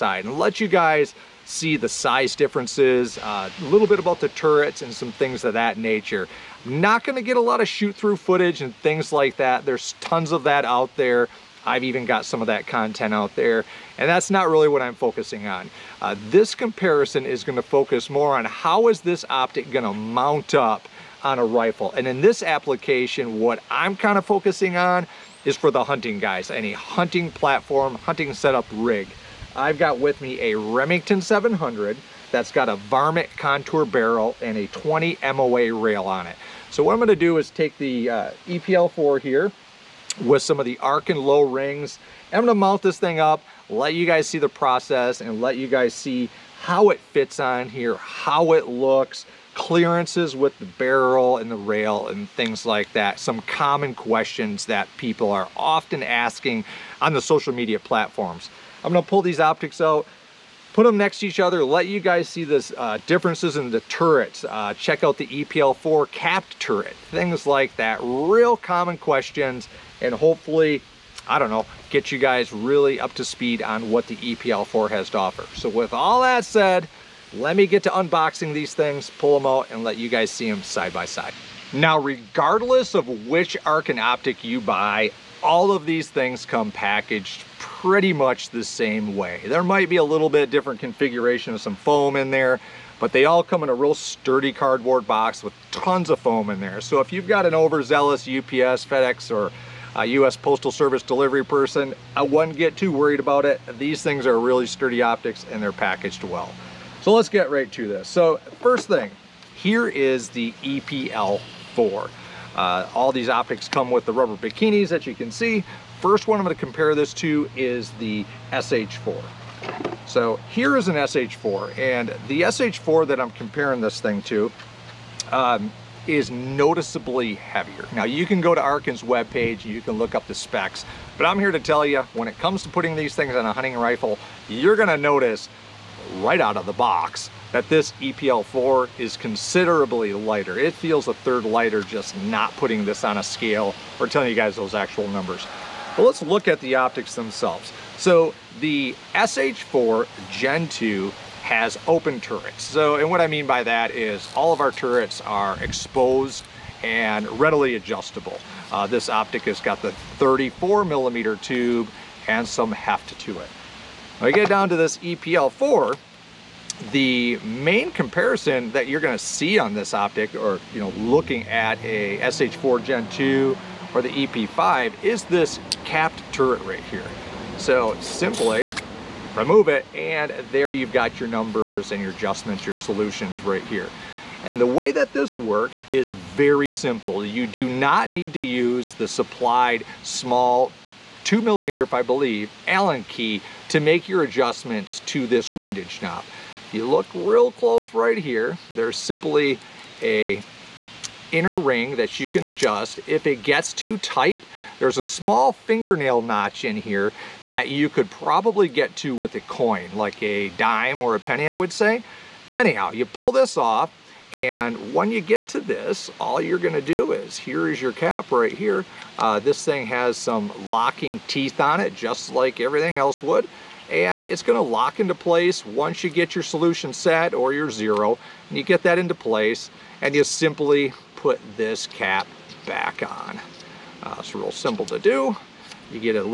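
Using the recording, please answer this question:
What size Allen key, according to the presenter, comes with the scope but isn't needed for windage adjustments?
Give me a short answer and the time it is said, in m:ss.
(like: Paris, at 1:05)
2 millimeter, at 3:11.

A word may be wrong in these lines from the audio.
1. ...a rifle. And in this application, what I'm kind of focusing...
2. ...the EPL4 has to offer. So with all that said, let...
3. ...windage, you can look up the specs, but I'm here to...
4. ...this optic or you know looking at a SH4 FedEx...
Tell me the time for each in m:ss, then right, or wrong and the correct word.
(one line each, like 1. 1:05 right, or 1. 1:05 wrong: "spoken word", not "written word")
1. 0:21 right
2. 1:14 right
3. 2:09 wrong: "webpage", not "windage"
4. 2:49 wrong: "Gen", not "FedEx".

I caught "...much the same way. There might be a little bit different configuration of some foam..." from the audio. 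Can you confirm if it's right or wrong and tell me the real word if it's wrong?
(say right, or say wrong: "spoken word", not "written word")
right.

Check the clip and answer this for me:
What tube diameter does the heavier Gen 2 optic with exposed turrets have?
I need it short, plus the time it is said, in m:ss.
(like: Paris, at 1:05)
34 millimeter, at 2:40.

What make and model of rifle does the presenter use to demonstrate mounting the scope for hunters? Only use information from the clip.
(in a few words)
Remington 700.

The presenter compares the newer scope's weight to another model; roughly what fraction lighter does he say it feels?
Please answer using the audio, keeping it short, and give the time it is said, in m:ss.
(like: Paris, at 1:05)
a third, at 2:21.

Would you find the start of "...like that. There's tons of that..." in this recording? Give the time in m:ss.
0:09.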